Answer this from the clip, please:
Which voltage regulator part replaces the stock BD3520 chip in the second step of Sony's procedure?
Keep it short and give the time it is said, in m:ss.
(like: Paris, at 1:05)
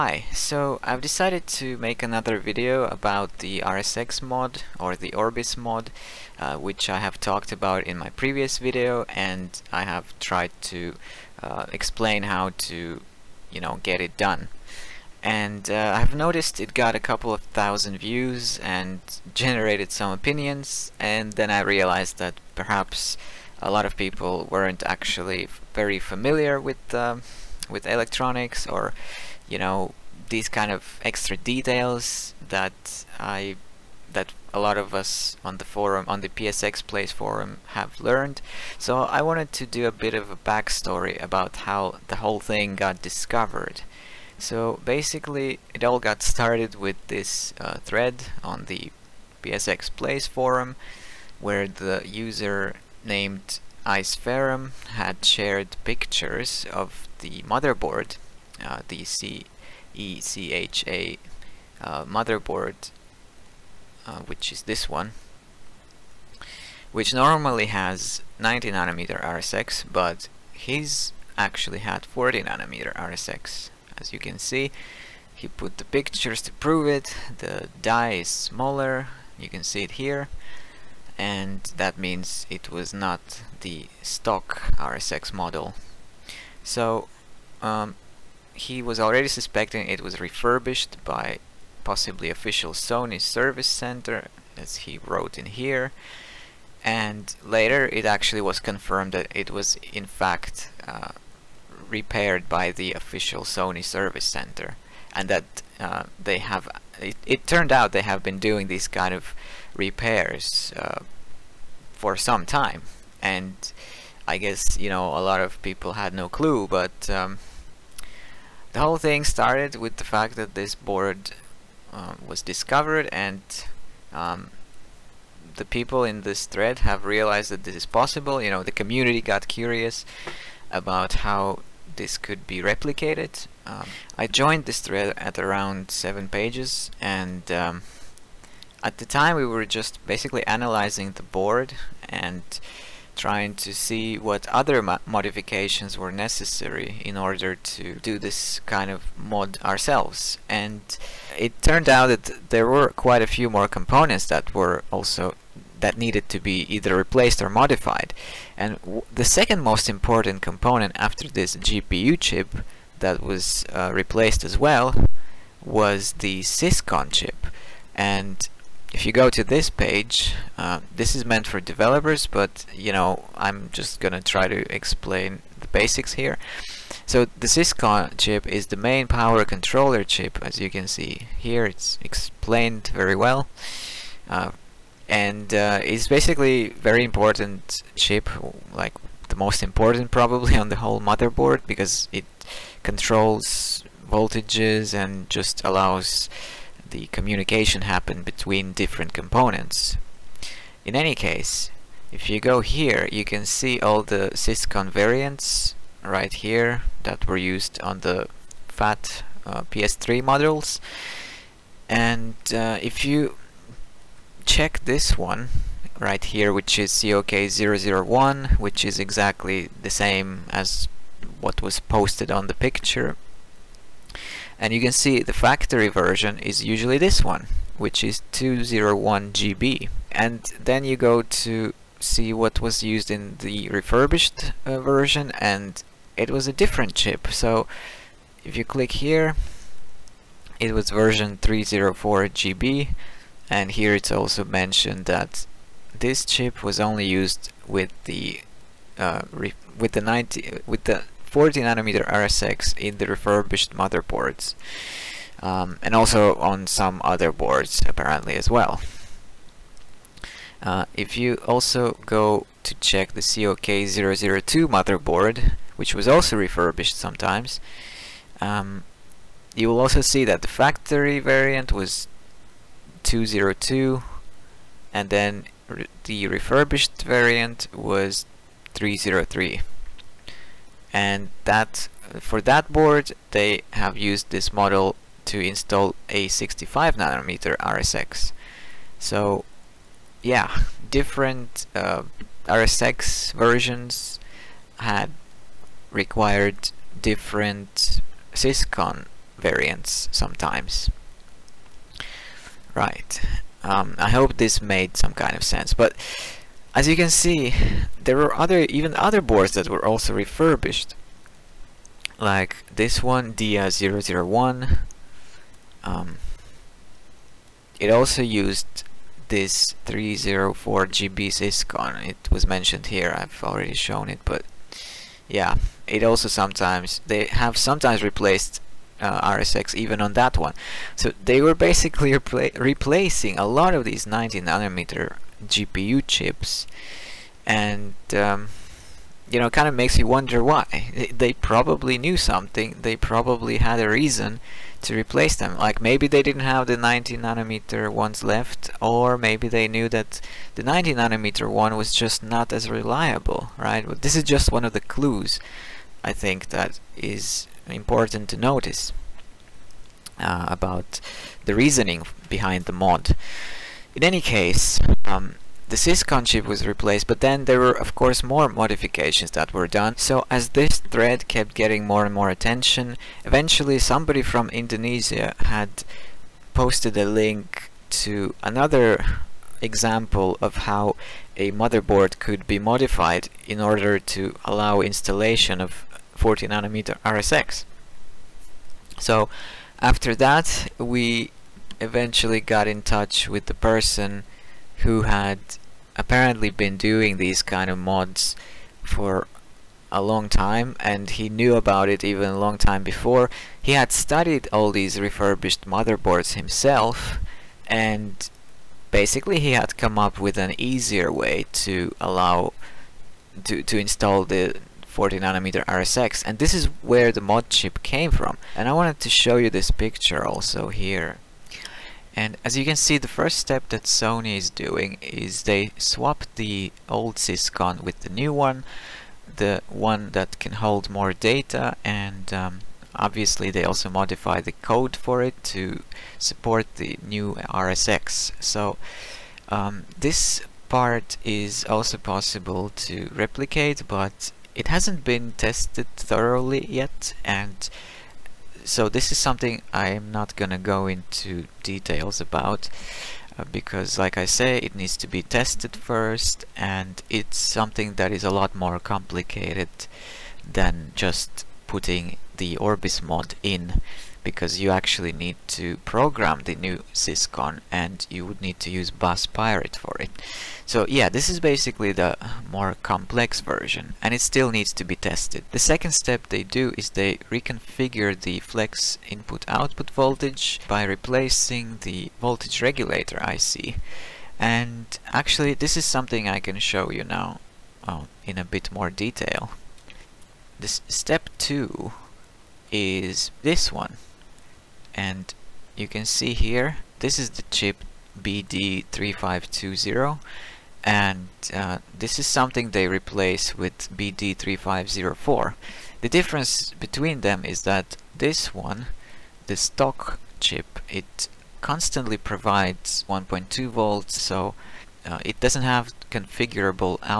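BD3504, at 8:23.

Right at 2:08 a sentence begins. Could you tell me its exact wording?
You know, the community got curious about how this could be replicated.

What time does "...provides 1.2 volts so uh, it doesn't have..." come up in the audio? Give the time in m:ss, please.
8:32.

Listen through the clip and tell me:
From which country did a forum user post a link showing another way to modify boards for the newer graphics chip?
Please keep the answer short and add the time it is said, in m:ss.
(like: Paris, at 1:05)
Indonesia, at 6:14.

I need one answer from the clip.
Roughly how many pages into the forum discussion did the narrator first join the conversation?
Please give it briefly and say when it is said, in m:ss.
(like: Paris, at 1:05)
7, at 2:15.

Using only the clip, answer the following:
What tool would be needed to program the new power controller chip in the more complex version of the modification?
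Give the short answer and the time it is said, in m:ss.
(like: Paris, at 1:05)
Bus Pirate, at 7:48.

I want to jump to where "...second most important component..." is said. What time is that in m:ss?
2:39.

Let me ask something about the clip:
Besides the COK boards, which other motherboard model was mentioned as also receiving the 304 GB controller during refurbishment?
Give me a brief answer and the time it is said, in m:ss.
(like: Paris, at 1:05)
DIA001, at 5:13.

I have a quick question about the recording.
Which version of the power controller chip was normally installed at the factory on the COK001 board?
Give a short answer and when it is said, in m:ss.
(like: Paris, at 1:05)
201 GB, at 3:48.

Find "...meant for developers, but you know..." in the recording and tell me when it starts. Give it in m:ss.
2:51.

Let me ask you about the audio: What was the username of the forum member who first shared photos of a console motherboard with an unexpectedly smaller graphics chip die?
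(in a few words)
Icferrum.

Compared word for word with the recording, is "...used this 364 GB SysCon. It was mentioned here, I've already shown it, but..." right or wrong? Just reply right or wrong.
wrong.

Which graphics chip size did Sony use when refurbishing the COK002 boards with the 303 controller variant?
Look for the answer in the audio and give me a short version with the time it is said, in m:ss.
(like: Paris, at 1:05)
65 nanometer, at 4:46.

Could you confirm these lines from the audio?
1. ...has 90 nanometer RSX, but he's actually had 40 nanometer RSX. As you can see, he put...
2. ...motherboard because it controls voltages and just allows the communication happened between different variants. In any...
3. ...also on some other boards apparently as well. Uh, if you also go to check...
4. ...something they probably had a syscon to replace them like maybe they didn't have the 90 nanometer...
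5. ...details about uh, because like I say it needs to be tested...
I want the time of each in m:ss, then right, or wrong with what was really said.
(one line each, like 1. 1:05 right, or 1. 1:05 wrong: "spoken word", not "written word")
1. 1:07 right
2. 3:10 wrong: "components", not "variants"
3. 4:15 right
4. 5:42 wrong: "reason", not "syscon"
5. 7:31 right.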